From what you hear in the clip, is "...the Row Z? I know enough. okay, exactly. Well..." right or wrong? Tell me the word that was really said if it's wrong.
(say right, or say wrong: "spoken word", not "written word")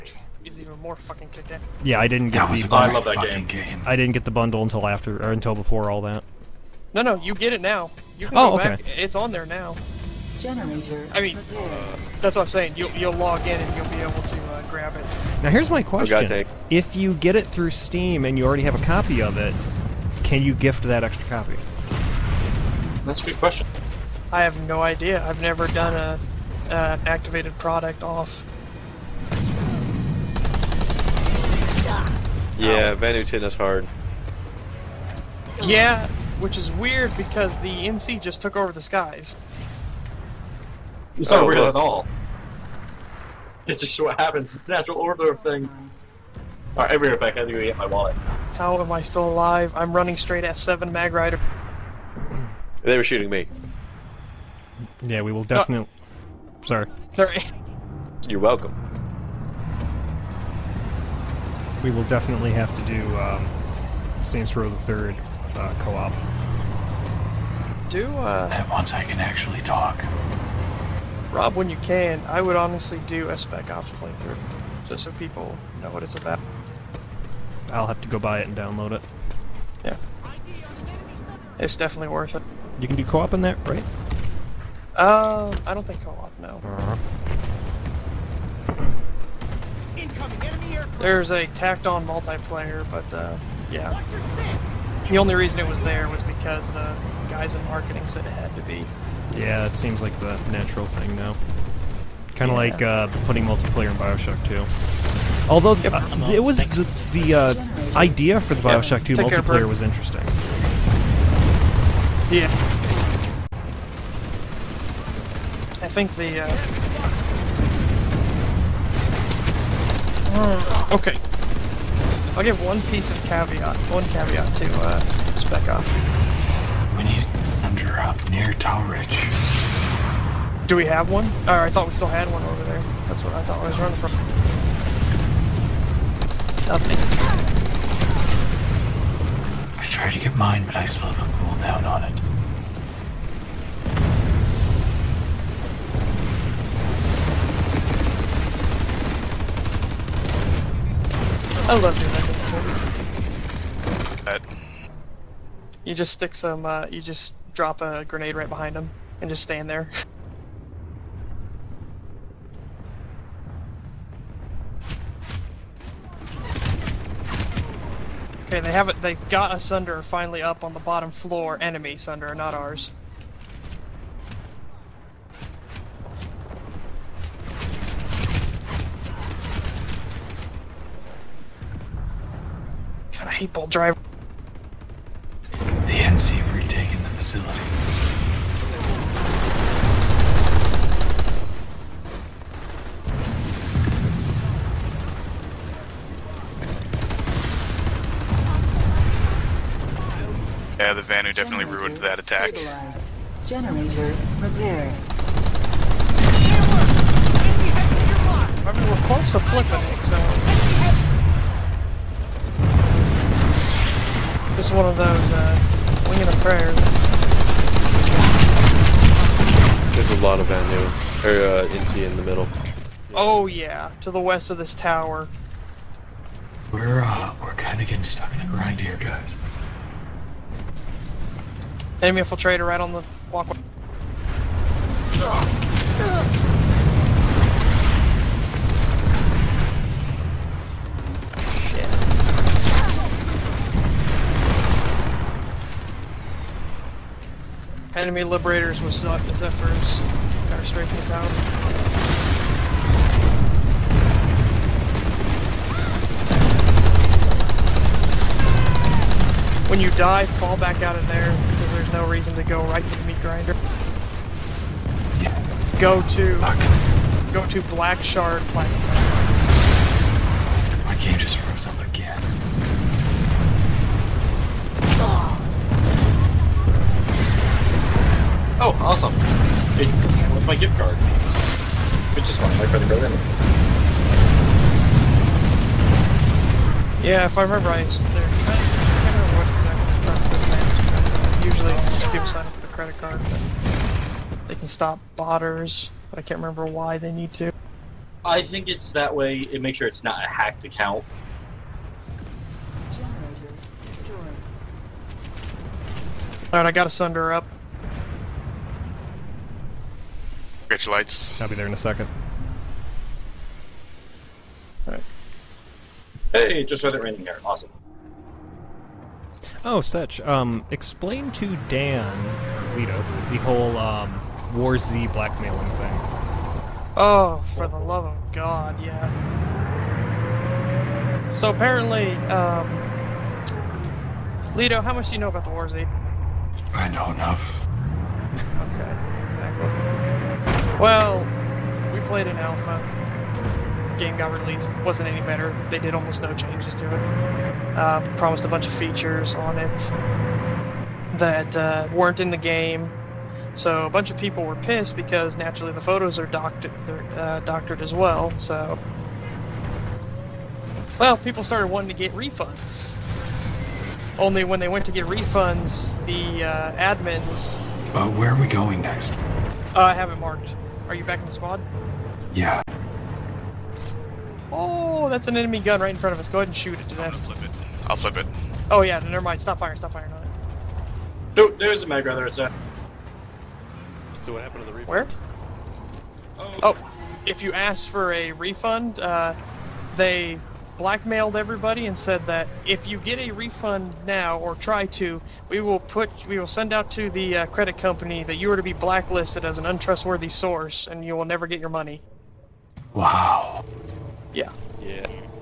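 wrong: "War", not "Row".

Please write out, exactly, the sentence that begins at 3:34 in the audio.
This is one of those, uh a prayer.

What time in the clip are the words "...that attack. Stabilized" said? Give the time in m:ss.
3:21.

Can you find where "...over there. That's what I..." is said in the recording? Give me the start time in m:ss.
2:12.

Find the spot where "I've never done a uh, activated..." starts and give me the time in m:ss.
0:25.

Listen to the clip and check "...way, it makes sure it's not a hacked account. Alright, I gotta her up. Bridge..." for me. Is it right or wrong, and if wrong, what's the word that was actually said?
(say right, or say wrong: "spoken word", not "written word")
right.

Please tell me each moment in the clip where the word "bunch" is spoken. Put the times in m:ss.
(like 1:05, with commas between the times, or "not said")
5:48, 5:53.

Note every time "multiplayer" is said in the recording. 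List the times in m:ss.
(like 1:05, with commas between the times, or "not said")
1:32, 1:43, 1:49.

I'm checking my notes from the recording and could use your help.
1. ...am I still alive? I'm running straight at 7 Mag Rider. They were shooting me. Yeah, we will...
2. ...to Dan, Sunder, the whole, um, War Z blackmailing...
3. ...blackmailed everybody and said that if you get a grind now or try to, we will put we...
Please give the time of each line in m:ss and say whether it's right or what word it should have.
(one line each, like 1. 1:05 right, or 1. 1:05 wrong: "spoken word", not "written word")
1. 0:48 right
2. 5:21 wrong: "Leto", not "Sunder"
3. 6:30 wrong: "refund", not "grind".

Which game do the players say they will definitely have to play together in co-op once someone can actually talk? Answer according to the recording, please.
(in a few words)
Saints Row the Third.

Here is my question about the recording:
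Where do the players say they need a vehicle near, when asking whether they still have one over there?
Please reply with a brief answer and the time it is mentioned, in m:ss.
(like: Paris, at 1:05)
Tawrich, at 2:08.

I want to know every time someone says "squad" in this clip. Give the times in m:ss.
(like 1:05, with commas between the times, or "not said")
6:11.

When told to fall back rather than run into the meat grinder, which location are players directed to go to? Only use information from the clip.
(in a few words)
Black Shard.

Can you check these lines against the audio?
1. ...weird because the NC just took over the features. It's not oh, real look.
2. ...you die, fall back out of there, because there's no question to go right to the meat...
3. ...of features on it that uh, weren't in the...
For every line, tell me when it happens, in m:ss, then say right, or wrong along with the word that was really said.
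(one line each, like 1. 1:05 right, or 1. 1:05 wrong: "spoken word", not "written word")
1. 0:36 wrong: "skies", not "features"
2. 4:19 wrong: "reason", not "question"
3. 5:48 right.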